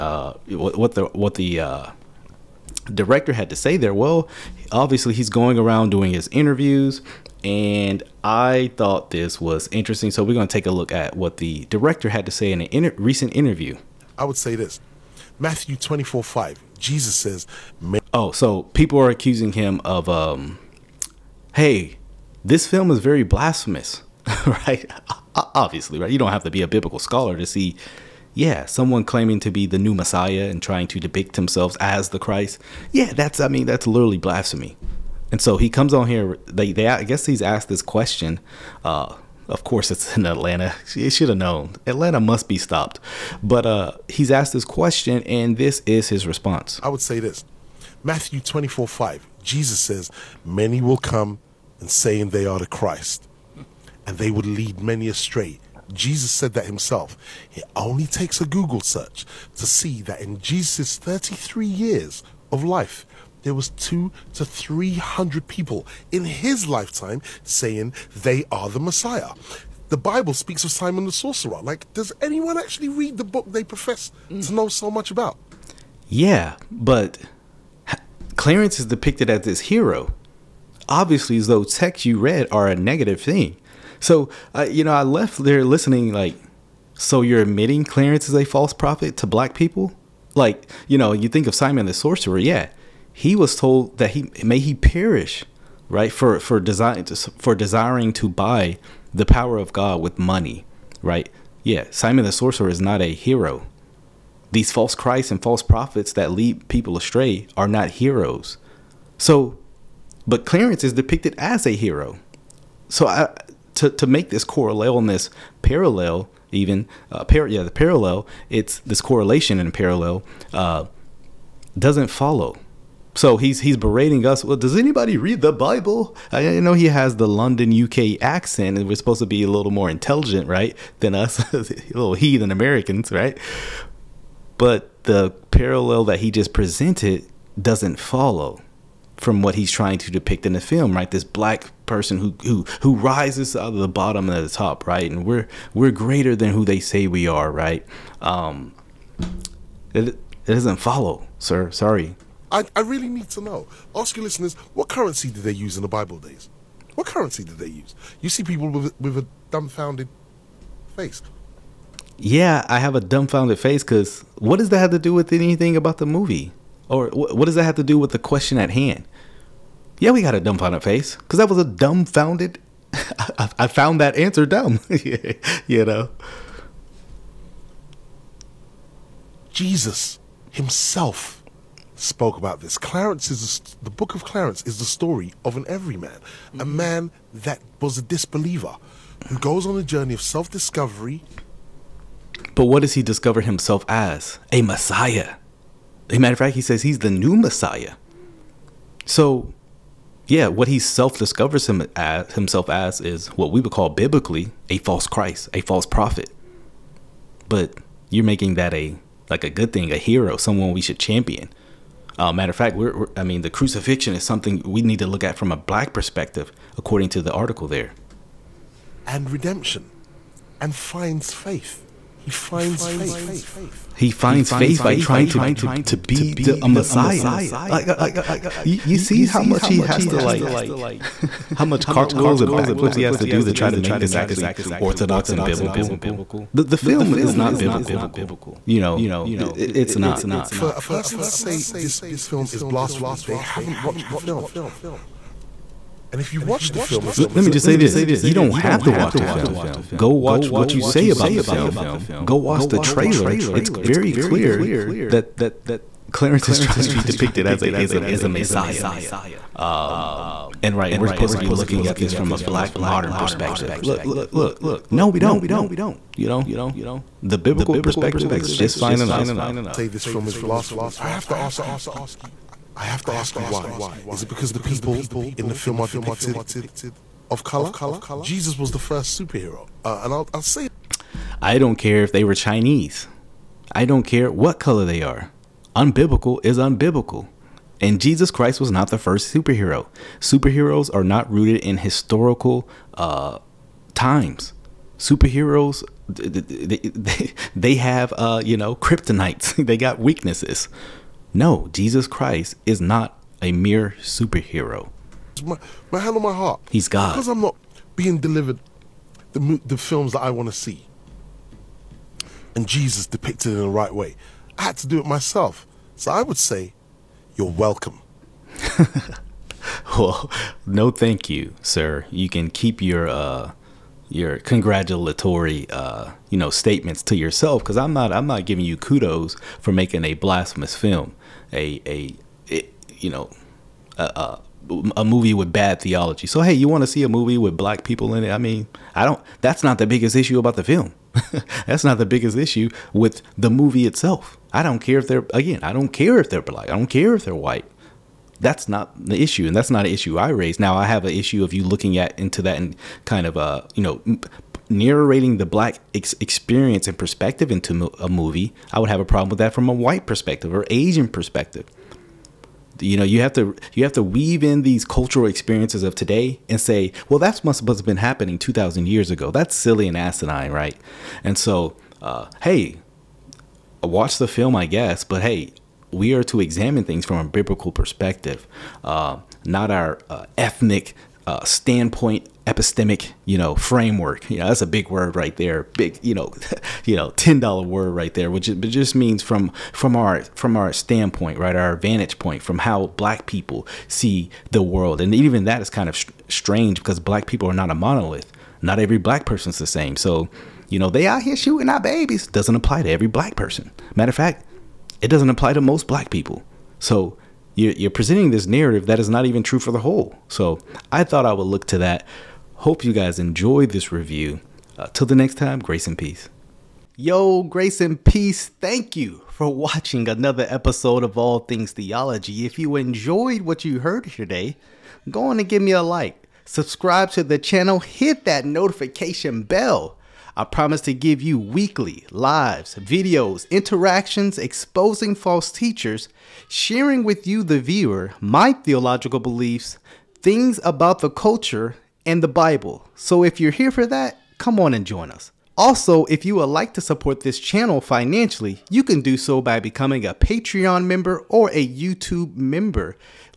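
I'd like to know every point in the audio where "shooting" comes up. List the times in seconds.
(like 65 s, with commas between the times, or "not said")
401 s.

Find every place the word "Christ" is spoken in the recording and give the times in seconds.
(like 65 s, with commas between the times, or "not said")
32 s, 52 s, 104 s, 205 s, 288 s, 302 s.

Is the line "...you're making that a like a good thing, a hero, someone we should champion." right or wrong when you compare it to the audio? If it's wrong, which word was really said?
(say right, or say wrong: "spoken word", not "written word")
right.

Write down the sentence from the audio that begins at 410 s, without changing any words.
So I thought I would look to that.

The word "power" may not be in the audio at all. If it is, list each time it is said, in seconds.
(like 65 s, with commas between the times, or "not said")
99 s.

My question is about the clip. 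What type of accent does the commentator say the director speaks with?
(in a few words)
London UK accent.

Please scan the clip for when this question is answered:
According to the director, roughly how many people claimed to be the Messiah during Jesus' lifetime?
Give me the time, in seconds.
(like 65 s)
63 s.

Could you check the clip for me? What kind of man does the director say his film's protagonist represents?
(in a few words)
An everyman.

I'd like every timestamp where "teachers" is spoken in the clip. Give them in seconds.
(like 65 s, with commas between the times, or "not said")
435 s.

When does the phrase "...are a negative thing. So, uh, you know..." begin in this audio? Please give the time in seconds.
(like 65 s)
82 s.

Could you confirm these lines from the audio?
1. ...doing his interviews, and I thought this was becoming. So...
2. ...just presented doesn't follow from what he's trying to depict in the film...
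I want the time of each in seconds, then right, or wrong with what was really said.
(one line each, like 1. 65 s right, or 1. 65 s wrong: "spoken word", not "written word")
1. 5 s wrong: "interesting", not "becoming"
2. 136 s right.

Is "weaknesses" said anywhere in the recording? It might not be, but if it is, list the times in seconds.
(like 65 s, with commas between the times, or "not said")
299 s.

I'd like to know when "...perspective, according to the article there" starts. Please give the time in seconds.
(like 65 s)
215 s.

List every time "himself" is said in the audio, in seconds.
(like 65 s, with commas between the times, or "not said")
56 s, 180 s, 193 s, 202 s.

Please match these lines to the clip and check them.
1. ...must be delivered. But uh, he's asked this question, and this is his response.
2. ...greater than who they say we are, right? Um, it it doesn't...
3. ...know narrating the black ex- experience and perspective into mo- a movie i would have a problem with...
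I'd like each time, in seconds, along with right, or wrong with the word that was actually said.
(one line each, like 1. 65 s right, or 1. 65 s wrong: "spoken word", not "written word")
1. 42 s wrong: "stopped", not "delivered"
2. 145 s right
3. 353 s right.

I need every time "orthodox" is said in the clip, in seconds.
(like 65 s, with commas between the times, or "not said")
234 s.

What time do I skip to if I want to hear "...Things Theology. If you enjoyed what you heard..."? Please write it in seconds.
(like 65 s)
421 s.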